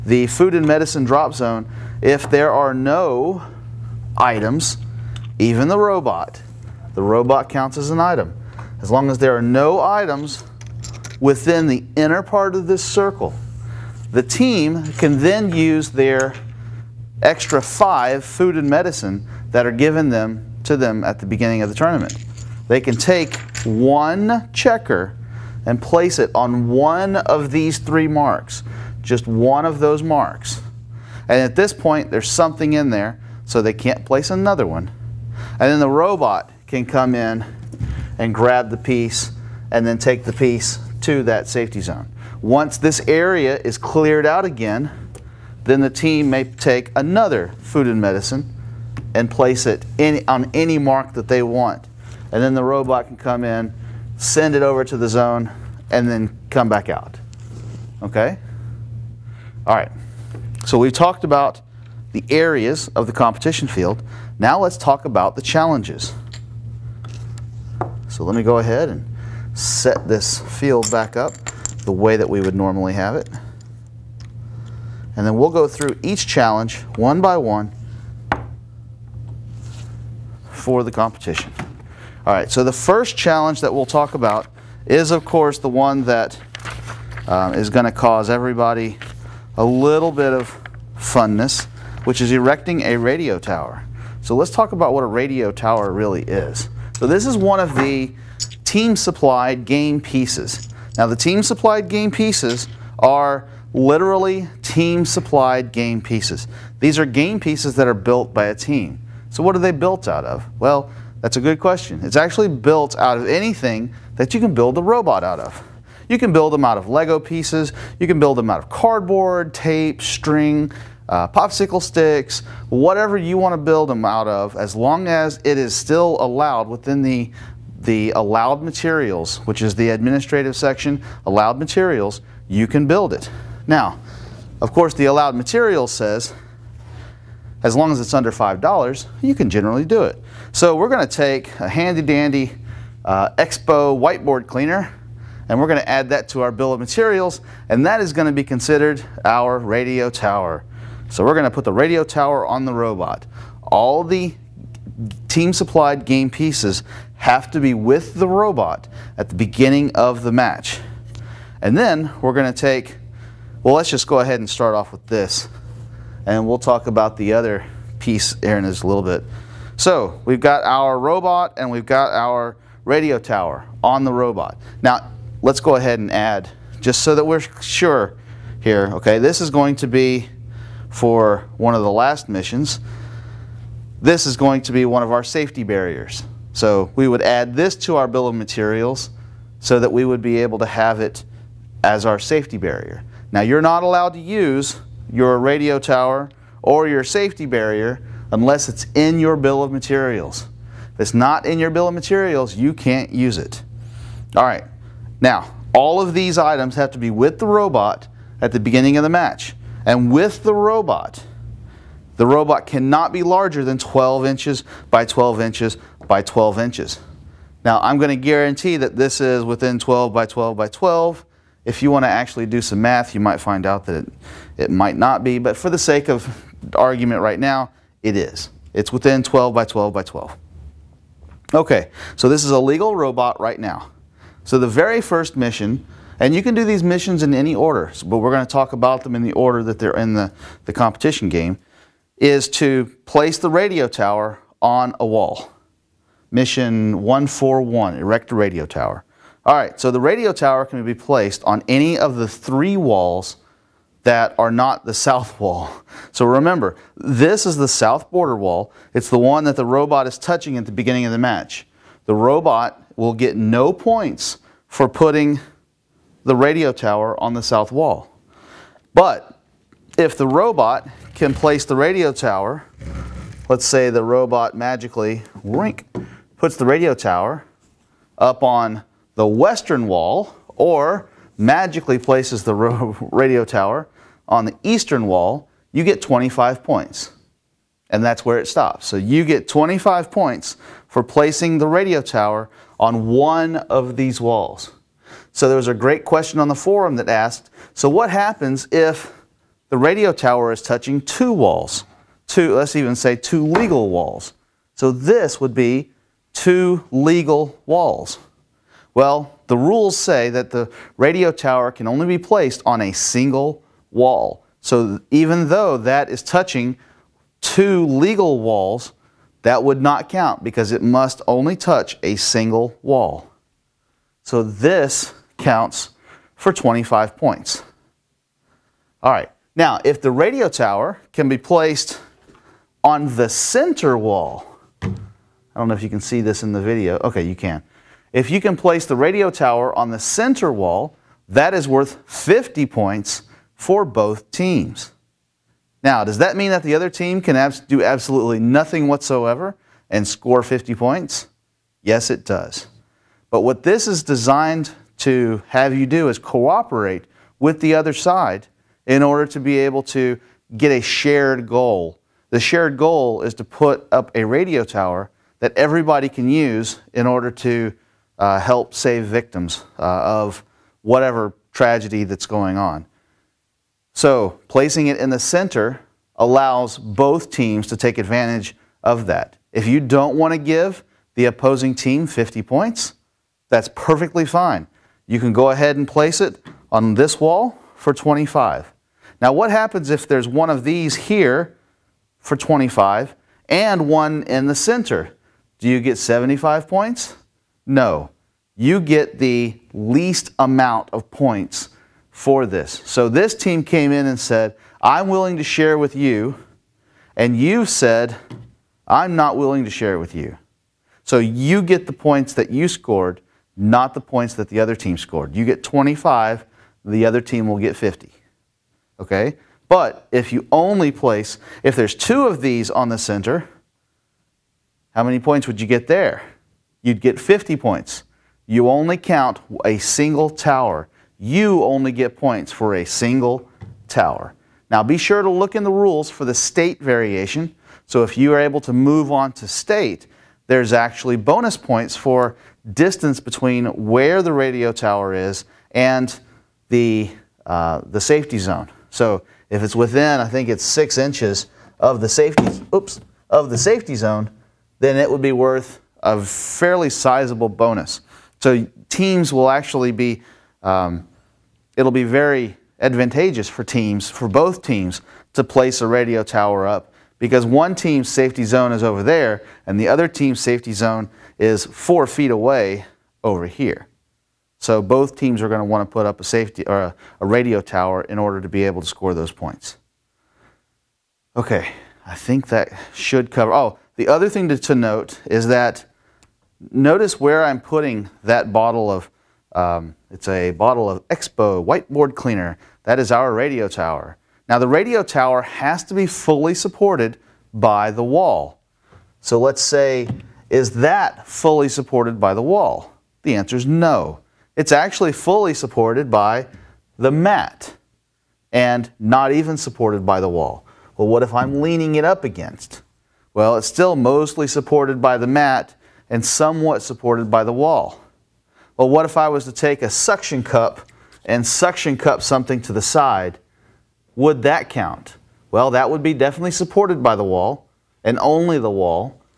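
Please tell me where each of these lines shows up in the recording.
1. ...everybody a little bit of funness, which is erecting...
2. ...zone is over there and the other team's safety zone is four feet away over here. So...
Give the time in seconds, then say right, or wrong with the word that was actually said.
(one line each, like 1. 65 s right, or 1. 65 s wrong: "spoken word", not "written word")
1. 88 s right
2. 468 s right.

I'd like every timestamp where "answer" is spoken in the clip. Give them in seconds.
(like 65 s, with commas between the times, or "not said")
503 s.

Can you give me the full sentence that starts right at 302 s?
Two, let's even say two legal walls.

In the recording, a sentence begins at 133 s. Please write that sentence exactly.
Now, of course, the allowed materials says, as long as it's under $5, you can generally do it.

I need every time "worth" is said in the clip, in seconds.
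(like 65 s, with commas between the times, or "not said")
341 s, 455 s.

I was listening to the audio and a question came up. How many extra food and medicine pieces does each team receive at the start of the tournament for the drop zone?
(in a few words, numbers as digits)
5.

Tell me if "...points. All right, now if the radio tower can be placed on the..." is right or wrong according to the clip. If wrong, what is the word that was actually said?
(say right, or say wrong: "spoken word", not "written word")
right.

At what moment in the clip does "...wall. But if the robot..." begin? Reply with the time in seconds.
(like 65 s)
267 s.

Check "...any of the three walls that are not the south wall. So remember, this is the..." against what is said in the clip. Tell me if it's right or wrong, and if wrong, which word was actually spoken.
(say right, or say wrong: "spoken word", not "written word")
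right.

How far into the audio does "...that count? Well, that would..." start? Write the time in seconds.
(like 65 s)
524 s.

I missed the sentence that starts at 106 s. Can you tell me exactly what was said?
These are game pieces that are built by a team.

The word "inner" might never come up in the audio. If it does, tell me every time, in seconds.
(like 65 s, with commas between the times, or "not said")
11 s.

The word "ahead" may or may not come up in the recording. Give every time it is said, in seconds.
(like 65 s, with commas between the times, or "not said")
68 s, 164 s, 175 s, 385 s.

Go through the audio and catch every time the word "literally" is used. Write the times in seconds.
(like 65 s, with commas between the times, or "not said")
103 s.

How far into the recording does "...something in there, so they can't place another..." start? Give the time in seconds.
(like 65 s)
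32 s.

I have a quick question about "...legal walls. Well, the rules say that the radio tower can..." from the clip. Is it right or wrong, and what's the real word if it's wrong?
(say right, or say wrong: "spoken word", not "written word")
right.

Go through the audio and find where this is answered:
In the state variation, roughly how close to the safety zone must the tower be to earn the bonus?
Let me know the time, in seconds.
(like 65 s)
450 s.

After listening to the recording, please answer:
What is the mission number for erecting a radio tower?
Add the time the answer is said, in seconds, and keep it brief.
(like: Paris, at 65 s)
141, at 247 s.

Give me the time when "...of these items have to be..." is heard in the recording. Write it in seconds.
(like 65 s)
205 s.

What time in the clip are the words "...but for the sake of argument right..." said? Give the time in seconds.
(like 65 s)
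225 s.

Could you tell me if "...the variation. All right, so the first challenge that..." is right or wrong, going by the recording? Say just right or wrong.
wrong.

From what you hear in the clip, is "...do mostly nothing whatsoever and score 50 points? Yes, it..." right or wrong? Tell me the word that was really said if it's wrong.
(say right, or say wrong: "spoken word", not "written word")
wrong: "absolutely", not "mostly".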